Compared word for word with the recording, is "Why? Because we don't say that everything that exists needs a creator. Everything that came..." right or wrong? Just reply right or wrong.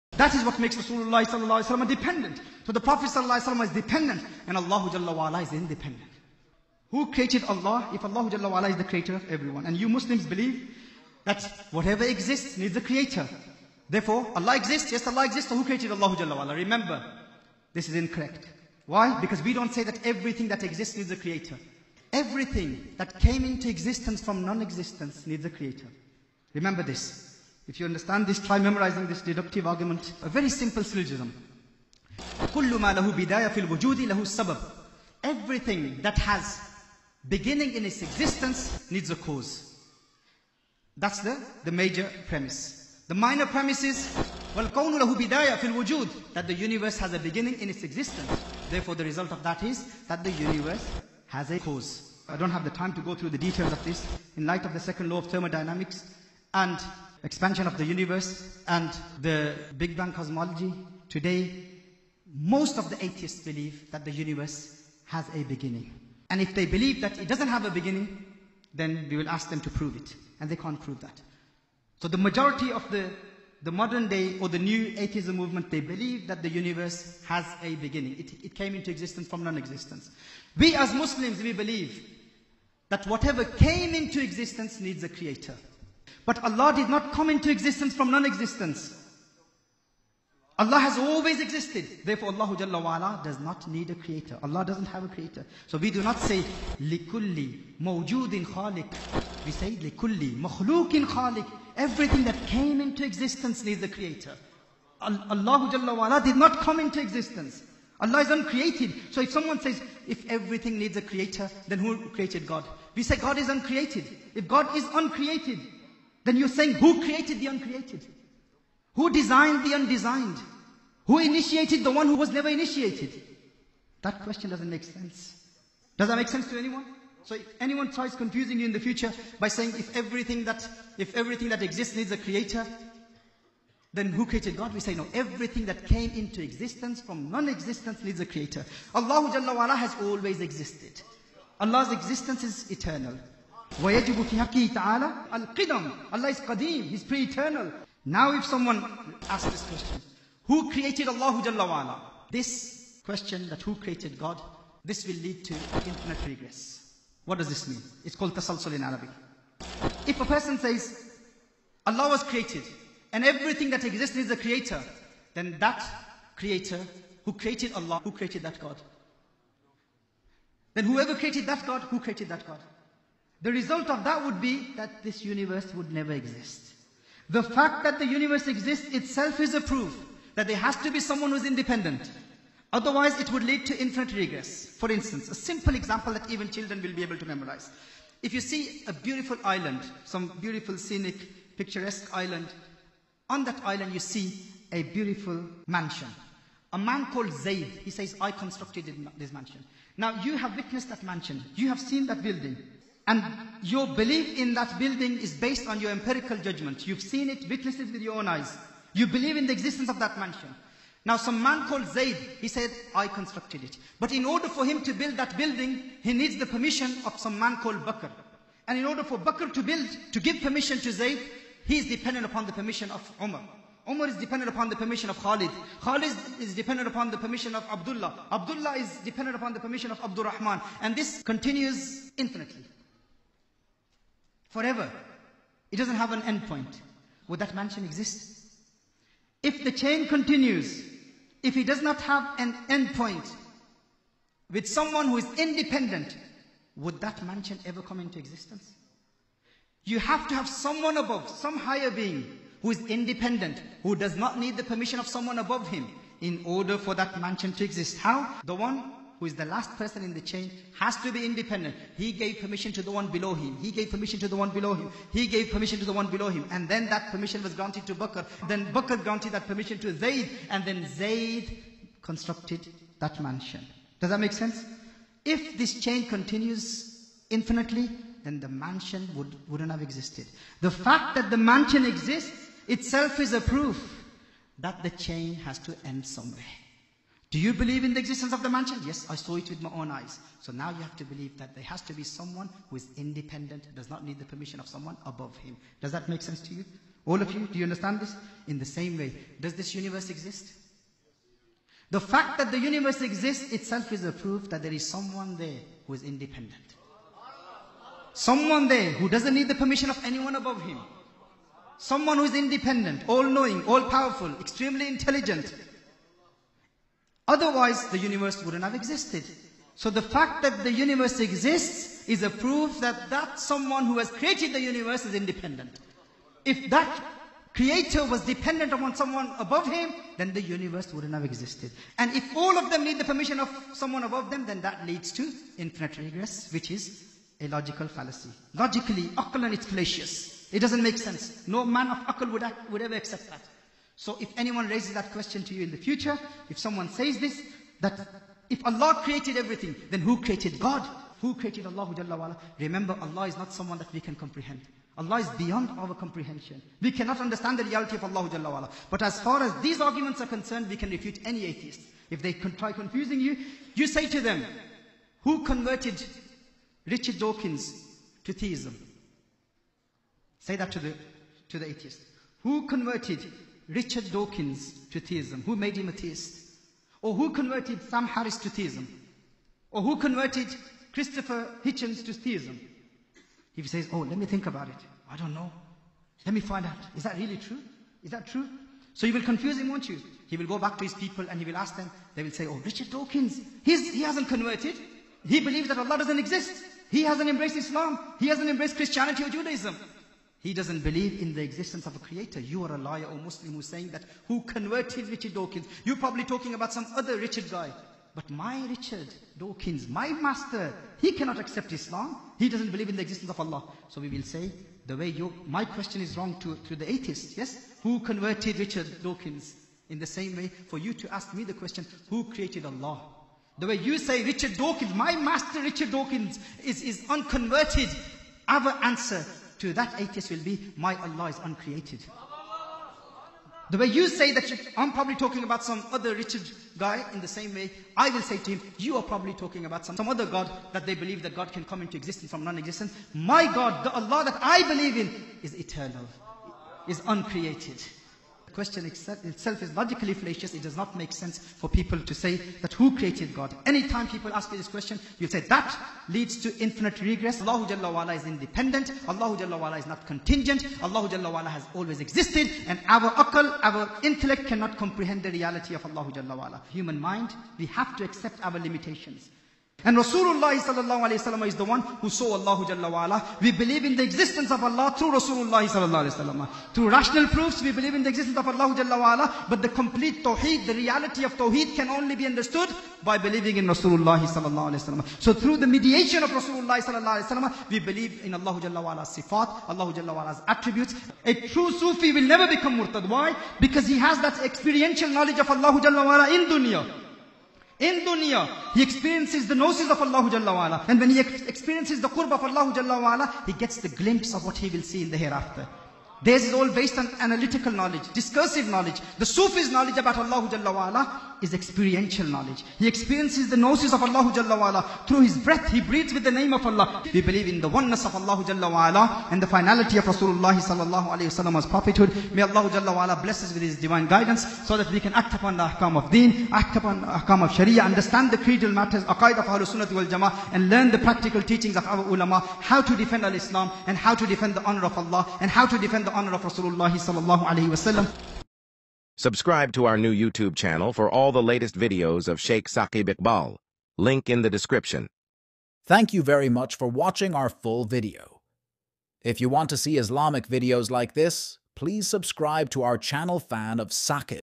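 right.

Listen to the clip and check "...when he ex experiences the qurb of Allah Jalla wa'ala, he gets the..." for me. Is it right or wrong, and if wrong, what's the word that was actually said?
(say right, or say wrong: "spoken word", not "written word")
right.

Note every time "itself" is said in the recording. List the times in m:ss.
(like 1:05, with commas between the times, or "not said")
2:58, 4:42, 5:03, 7:28.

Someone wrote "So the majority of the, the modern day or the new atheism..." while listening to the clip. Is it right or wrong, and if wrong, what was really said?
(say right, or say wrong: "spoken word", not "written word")
right.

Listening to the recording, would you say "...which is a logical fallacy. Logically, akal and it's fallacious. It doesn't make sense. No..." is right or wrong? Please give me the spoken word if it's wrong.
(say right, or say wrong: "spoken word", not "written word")
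right.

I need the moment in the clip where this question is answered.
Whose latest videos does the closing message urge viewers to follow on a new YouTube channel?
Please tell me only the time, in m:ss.
9:02.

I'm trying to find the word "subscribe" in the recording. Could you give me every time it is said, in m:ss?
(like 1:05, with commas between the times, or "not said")
8:59, 9:12.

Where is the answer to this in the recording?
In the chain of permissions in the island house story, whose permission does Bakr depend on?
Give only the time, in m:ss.
3:42.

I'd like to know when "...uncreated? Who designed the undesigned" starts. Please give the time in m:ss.
1:57.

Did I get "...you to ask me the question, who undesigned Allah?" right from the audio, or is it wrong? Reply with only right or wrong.
wrong.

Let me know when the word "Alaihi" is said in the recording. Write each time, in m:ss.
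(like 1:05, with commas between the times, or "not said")
8:41, 8:57.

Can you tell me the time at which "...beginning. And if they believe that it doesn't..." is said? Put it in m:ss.
1:05.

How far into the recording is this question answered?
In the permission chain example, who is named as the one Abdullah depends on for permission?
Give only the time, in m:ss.
3:50.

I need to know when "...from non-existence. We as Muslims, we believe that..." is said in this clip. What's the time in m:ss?
1:19.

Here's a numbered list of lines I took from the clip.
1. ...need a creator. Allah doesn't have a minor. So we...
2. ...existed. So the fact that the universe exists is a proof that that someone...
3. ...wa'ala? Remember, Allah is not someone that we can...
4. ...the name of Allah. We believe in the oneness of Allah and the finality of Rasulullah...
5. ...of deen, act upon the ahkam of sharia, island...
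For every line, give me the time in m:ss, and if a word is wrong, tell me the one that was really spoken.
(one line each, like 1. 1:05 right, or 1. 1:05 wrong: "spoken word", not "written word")
1. 1:33 wrong: "creator", not "minor"
2. 5:18 right
3. 5:52 right
4. 8:36 right
5. 8:45 wrong: "understand", not "island".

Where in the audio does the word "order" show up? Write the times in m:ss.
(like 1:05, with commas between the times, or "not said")
3:34, 3:38, 4:16.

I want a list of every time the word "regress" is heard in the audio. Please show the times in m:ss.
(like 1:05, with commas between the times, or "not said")
2:36, 3:04, 5:35, 7:37.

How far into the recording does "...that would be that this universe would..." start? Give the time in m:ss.
2:54.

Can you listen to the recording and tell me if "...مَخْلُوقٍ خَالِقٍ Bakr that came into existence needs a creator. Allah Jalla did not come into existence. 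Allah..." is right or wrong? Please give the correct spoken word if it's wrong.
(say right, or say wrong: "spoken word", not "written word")
wrong: "Everything", not "Bakr".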